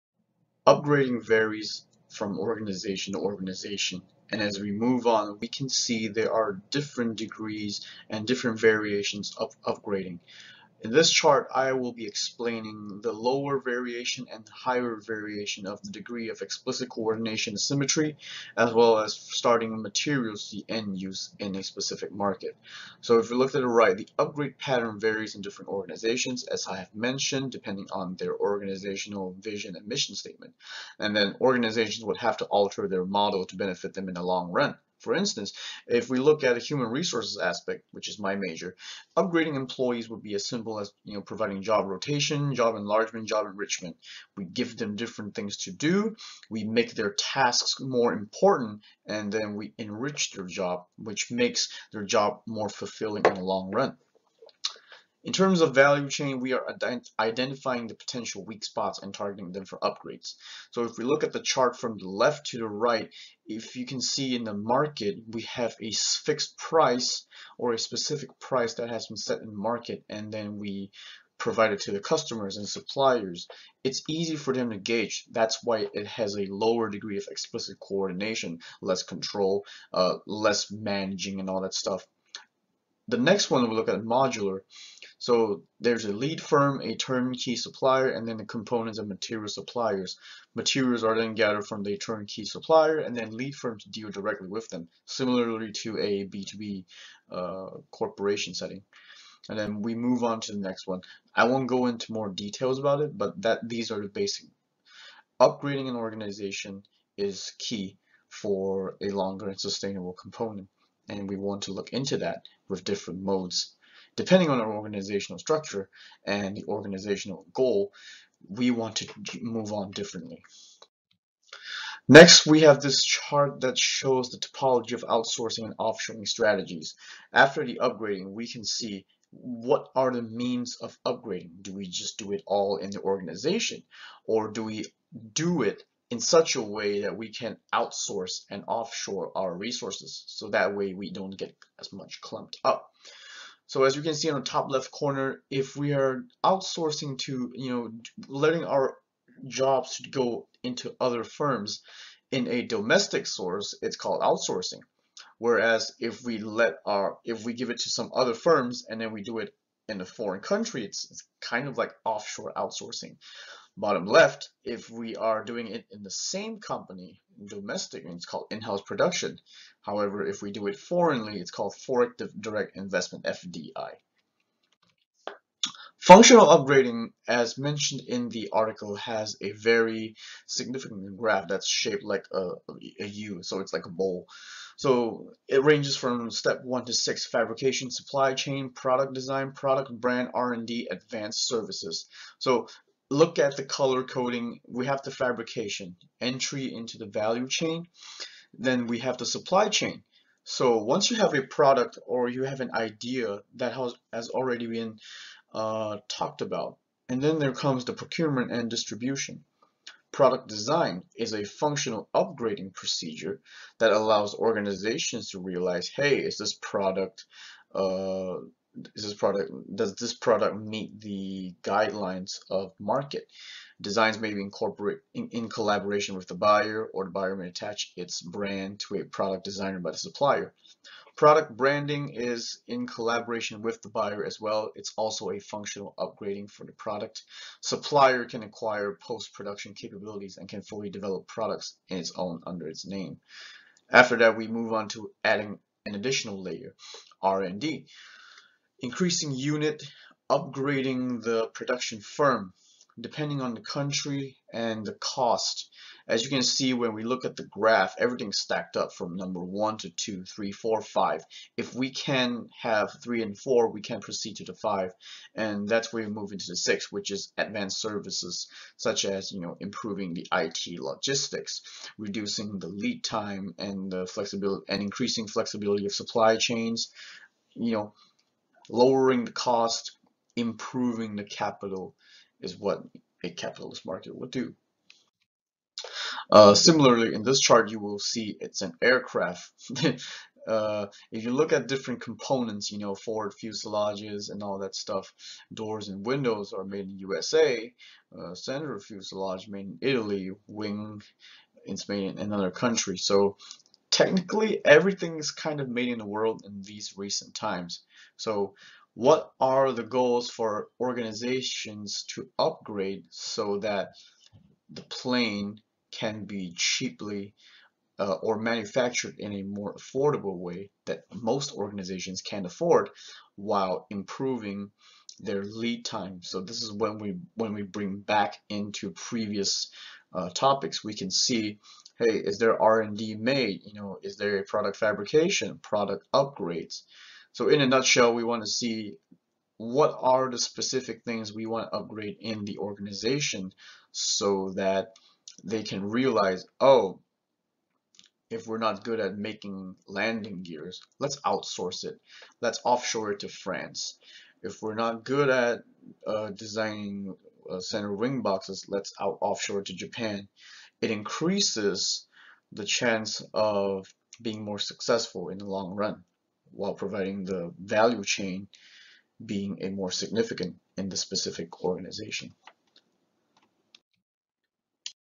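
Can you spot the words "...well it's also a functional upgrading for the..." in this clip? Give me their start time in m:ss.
3:54.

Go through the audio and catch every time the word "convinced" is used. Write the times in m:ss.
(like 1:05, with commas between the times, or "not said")
not said.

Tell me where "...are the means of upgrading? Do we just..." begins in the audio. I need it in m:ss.
2:09.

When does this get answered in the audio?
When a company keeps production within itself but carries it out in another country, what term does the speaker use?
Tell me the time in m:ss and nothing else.
2:51.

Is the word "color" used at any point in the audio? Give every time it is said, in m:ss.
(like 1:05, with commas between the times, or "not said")
3:13.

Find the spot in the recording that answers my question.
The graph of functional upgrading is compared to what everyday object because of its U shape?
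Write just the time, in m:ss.
3:03.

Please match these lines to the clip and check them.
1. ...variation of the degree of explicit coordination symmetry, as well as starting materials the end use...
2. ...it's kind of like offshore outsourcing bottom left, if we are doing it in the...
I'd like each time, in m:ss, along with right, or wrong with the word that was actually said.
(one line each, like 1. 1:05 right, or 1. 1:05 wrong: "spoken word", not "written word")
1. 0:14 right
2. 2:41 right.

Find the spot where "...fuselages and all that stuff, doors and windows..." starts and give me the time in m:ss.
4:53.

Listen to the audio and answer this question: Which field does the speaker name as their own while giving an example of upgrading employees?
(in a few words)
Human resources.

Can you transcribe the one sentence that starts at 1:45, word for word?
Upgrading an organization is key for a longer and sustainable component and we want to look into that with different modes.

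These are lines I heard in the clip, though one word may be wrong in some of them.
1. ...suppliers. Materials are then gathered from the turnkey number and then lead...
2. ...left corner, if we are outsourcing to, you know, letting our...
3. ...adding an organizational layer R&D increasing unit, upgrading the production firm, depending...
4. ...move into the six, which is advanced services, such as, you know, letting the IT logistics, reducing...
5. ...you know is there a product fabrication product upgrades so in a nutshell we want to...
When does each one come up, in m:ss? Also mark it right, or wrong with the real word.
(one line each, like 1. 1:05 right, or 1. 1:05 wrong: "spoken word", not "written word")
1. 1:29 wrong: "supplier", not "number"
2. 2:24 right
3. 4:05 wrong: "additional", not "organizational"
4. 4:26 wrong: "improving", not "letting"
5. 5:33 right.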